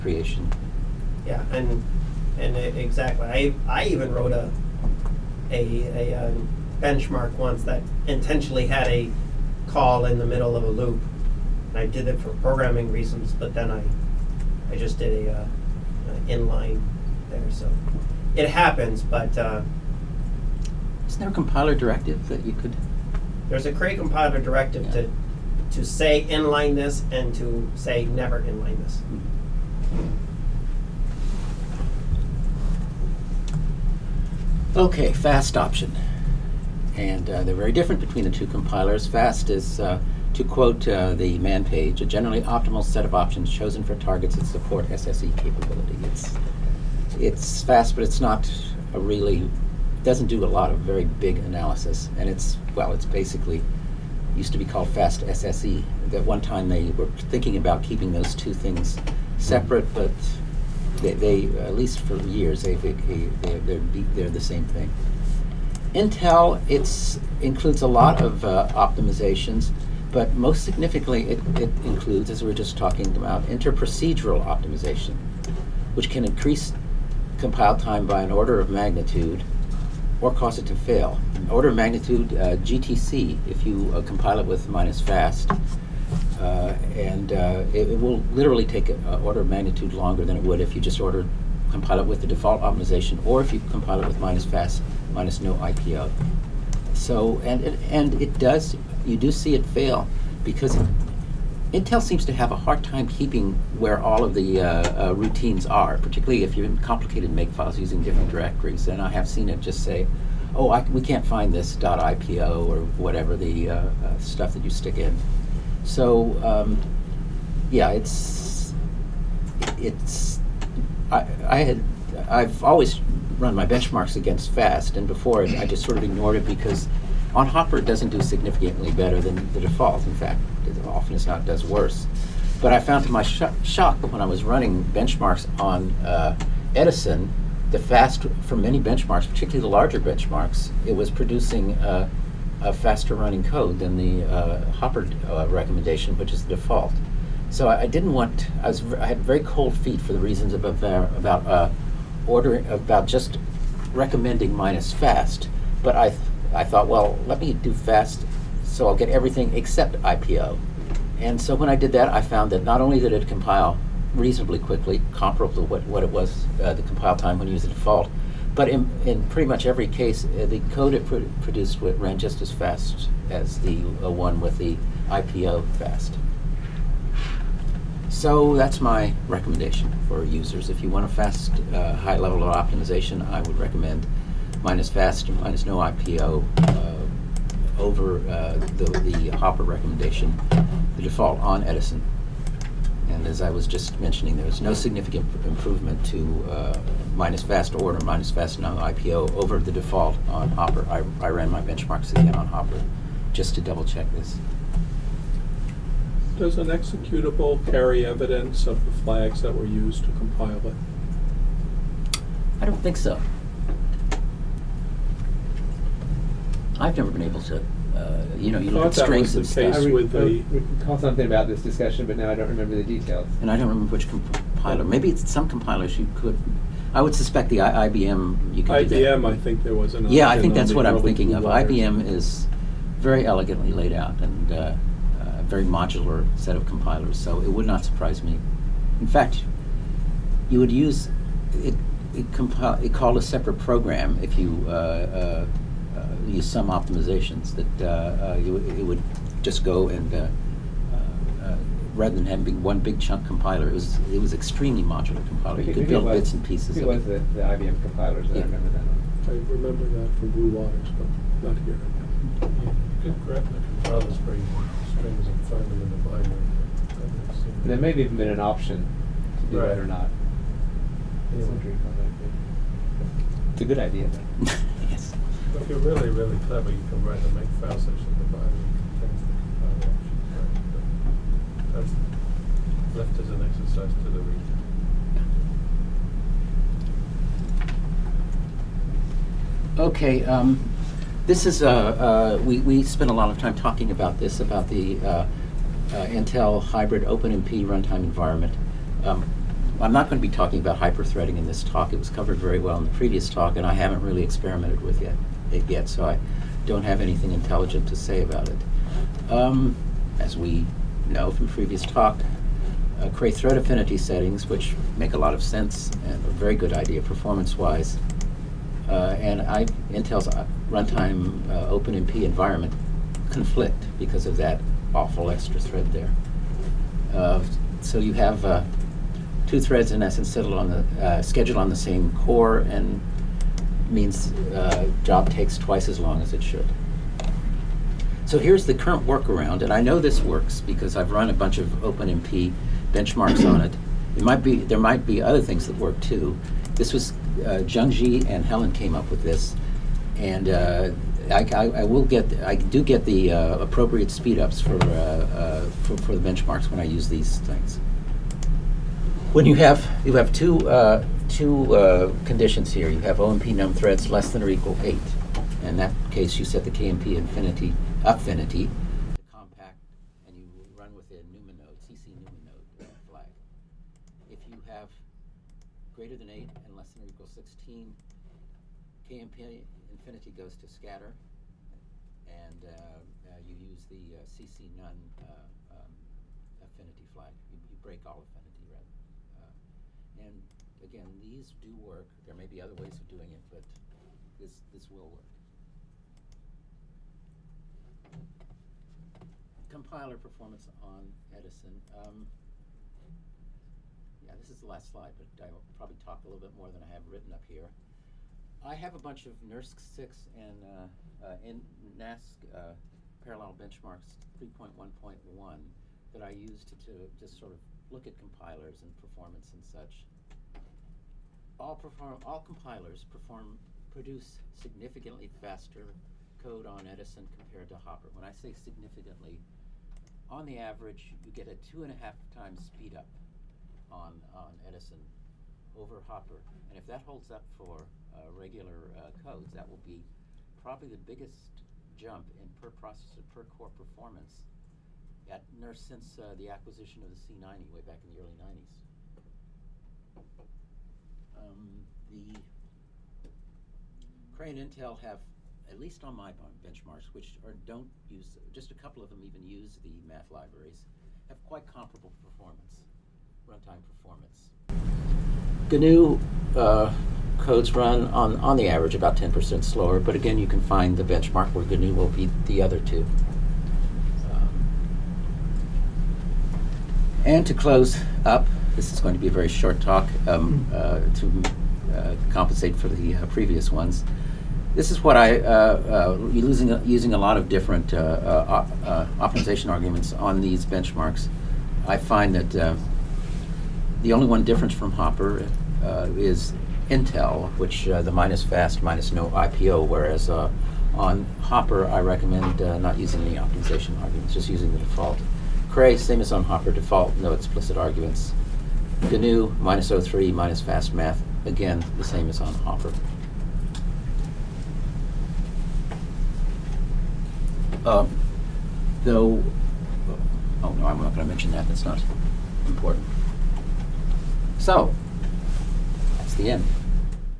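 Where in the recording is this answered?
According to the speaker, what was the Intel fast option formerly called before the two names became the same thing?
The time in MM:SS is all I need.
00:54.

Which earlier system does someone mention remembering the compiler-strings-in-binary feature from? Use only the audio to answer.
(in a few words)
Blue Waters.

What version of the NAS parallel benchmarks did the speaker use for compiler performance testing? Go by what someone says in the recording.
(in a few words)
3.1.1.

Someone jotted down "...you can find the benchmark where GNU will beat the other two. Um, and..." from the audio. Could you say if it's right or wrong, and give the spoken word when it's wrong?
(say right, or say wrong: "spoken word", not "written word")
right.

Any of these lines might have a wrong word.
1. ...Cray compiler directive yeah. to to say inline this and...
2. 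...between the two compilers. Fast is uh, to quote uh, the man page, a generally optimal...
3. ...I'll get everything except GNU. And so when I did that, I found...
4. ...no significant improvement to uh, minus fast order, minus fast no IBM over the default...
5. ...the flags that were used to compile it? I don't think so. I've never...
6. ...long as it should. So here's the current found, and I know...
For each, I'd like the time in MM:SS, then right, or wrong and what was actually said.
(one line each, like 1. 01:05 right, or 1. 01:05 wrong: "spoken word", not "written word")
1. 00:23 right
2. 00:38 right
3. 02:38 wrong: "IPO", not "GNU"
4. 03:14 wrong: "IPO", not "IBM"
5. 03:28 right
6. 05:35 wrong: "workaround", not "found".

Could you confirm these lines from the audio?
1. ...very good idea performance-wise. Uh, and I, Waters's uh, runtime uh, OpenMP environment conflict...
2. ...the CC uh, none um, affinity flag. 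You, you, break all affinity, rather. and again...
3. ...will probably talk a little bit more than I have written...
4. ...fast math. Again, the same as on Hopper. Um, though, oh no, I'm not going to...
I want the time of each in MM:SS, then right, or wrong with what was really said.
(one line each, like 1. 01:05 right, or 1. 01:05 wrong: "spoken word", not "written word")
1. 05:16 wrong: "Intel", not "Waters"
2. 06:23 right
3. 06:45 right
4. 08:30 right.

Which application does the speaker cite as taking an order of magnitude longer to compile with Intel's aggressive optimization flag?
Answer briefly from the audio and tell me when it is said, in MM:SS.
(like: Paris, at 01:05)
GTC, at 01:22.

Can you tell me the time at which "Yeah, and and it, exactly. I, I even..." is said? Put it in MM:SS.
00:01.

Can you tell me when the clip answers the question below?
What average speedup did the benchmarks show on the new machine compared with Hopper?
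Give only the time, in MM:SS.
07:11.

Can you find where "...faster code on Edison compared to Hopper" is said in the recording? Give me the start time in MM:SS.
07:05.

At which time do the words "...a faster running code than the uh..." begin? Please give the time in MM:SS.
02:22.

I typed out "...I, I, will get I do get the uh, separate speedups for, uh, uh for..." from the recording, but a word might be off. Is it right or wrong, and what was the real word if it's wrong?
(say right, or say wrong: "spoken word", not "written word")
wrong: "appropriate", not "separate".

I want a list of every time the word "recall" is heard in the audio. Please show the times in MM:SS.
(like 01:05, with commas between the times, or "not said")
03:40.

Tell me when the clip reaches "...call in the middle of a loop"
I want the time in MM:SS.
00:09.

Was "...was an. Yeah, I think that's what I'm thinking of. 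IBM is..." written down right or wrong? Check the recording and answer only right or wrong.
right.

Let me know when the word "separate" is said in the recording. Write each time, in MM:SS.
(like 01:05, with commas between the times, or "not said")
00:59, 04:03.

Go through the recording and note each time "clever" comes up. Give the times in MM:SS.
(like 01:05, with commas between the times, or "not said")
04:36.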